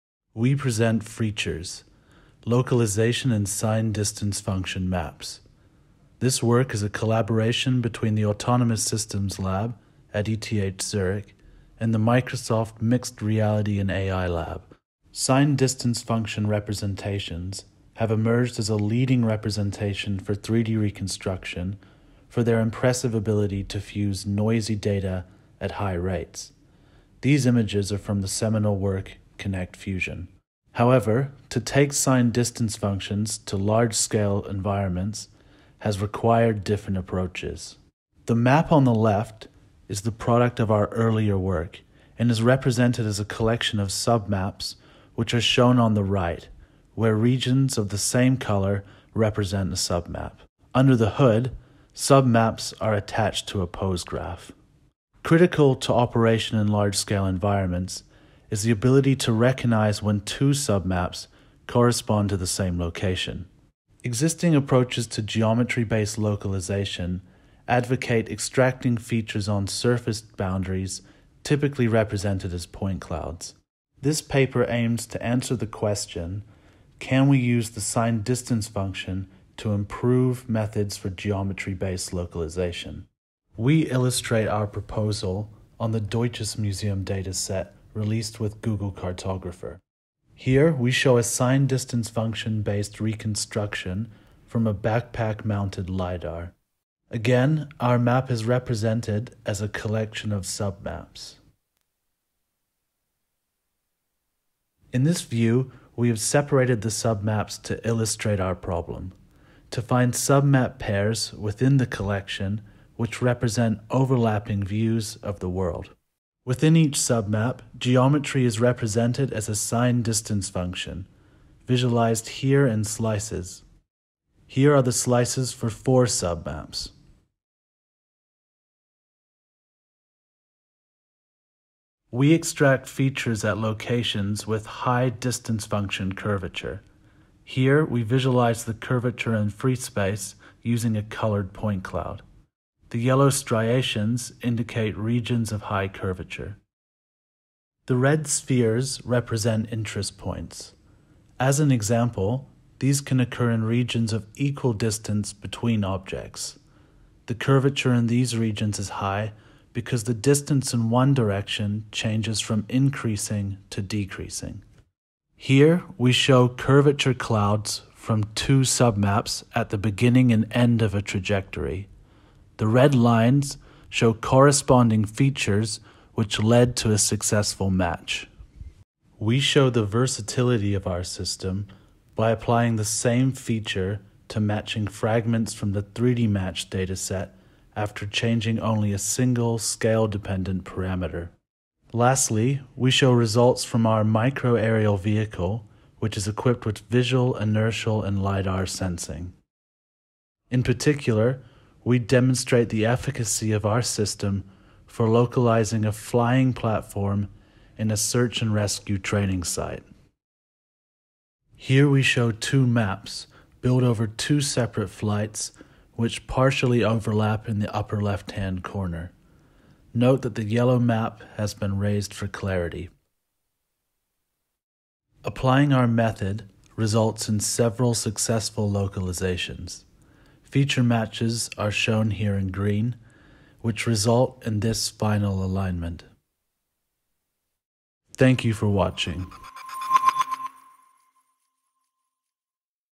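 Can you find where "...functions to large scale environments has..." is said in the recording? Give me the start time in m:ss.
0:32.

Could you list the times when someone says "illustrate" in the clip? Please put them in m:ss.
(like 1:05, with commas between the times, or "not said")
1:23, 1:47.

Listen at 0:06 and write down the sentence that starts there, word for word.
This work is a collaboration between the Autonomous Systems Lab at ETH Zurich and the Microsoft Mixed Reality and AI Lab.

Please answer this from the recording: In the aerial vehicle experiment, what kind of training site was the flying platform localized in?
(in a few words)
search and rescue.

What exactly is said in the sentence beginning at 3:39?
Note that the yellow map has been raised for clarity.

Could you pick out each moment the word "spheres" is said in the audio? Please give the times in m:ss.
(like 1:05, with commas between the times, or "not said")
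2:28.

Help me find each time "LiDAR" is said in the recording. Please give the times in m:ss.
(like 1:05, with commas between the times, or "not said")
1:35, 3:18.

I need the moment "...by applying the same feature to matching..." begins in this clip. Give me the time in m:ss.
3:02.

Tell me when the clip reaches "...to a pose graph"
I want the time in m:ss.
0:53.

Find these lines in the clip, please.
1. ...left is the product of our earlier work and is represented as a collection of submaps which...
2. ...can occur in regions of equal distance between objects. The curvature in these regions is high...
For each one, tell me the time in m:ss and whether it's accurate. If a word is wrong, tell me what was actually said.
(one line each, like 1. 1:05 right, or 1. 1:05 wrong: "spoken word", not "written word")
1. 0:38 right
2. 2:32 right.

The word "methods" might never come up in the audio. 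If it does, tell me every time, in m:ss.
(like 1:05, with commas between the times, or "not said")
1:20, 3:45.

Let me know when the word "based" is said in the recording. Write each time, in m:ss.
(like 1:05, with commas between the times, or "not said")
1:05, 1:21, 1:32.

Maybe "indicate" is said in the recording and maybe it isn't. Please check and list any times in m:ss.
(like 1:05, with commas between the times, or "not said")
2:24.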